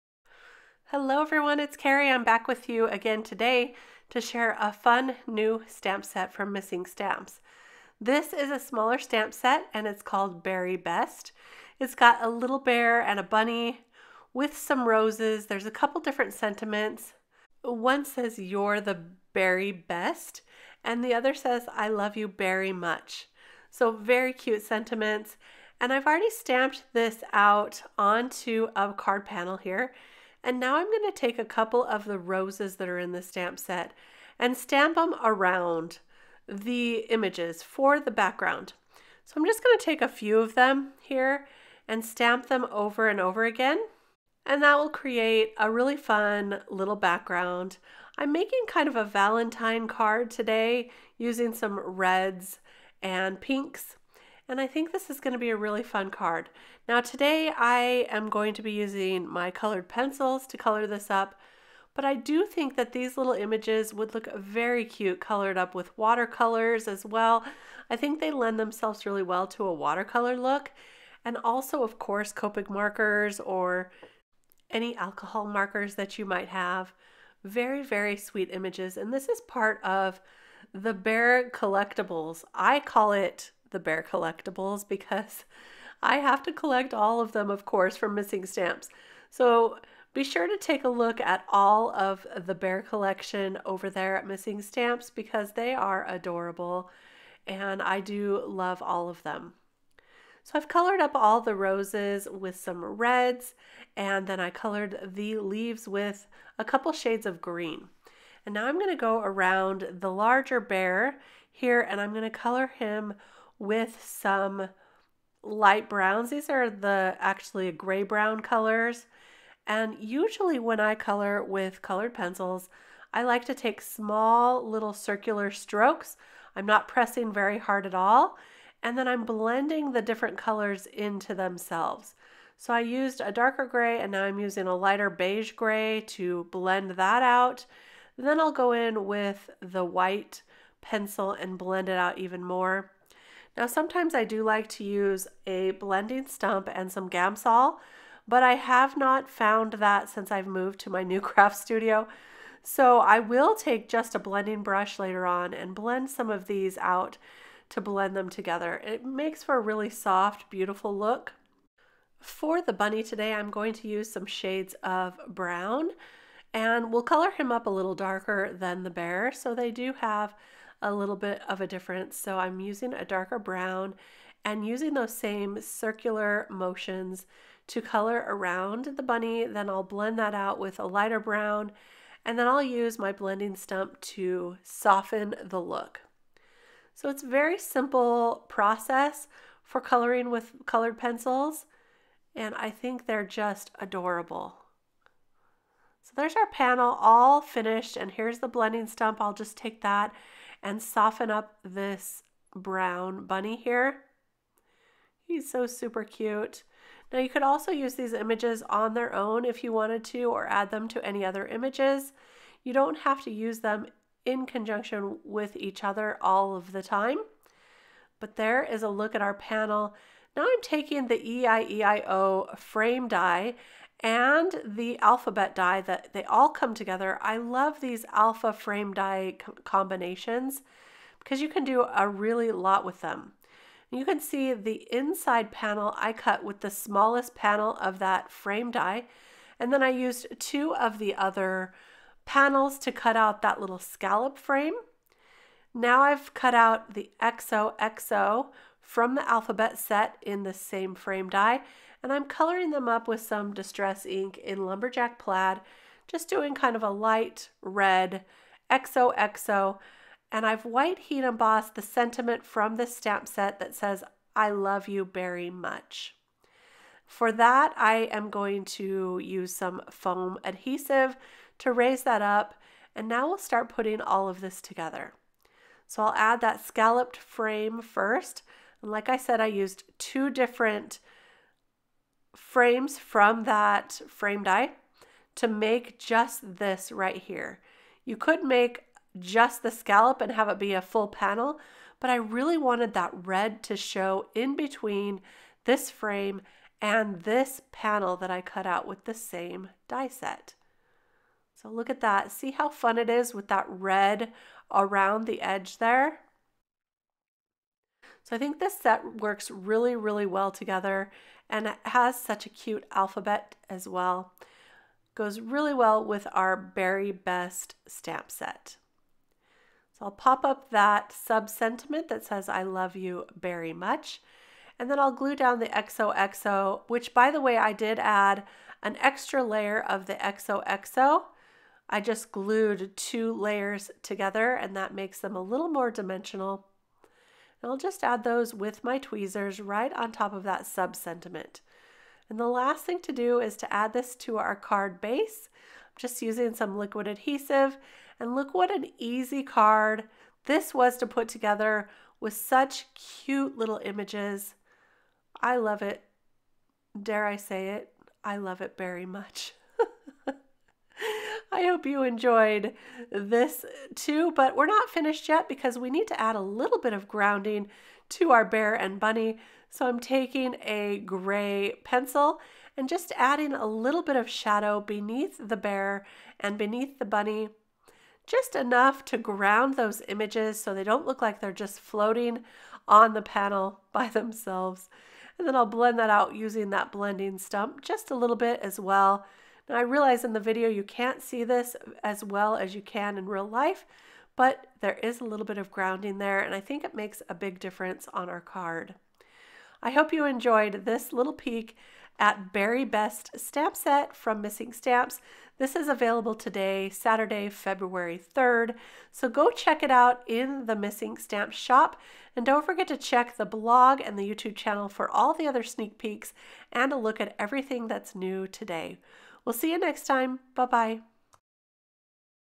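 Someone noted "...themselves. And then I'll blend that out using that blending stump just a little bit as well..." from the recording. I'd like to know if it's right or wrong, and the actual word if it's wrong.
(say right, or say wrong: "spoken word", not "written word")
right.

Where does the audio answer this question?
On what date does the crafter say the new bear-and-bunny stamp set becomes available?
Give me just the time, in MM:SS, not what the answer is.
06:46.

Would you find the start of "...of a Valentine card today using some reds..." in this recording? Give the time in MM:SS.
00:48.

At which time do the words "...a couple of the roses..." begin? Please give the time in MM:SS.
00:31.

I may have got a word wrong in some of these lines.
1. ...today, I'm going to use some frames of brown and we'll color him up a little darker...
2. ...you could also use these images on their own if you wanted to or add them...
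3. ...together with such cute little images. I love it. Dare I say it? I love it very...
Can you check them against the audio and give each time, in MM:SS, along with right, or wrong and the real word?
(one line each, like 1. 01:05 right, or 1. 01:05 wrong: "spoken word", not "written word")
1. 02:43 wrong: "shades", not "frames"
2. 03:27 right
3. 05:51 right.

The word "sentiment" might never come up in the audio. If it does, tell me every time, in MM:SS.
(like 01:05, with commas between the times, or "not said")
00:16, 00:24, 04:21, 05:21, 05:40.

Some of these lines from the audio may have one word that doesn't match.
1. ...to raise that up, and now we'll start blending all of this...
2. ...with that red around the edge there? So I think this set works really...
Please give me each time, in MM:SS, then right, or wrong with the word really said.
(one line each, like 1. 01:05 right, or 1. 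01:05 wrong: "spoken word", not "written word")
1. 04:31 wrong: "putting", not "blending"
2. 05:03 right.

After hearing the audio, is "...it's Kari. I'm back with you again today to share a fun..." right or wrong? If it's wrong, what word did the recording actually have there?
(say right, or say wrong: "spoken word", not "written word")
right.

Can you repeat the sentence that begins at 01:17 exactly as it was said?
Very, very sweet images, and this is part of the Bear Collectibles.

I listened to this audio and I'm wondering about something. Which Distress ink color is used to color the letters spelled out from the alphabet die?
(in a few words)
Lumberjack Plaid.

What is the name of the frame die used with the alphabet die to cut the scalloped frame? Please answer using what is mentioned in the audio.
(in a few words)
EIEIO.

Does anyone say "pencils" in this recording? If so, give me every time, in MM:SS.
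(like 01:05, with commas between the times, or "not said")
00:59, 02:02, 02:20, 03:10, 06:11.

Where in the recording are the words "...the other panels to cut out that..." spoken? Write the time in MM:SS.
04:00.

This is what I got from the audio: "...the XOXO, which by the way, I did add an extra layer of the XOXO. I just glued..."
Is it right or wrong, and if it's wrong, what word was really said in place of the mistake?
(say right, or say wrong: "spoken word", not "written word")
right.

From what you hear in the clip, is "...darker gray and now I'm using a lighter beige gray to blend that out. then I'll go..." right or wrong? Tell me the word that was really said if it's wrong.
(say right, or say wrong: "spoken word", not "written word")
right.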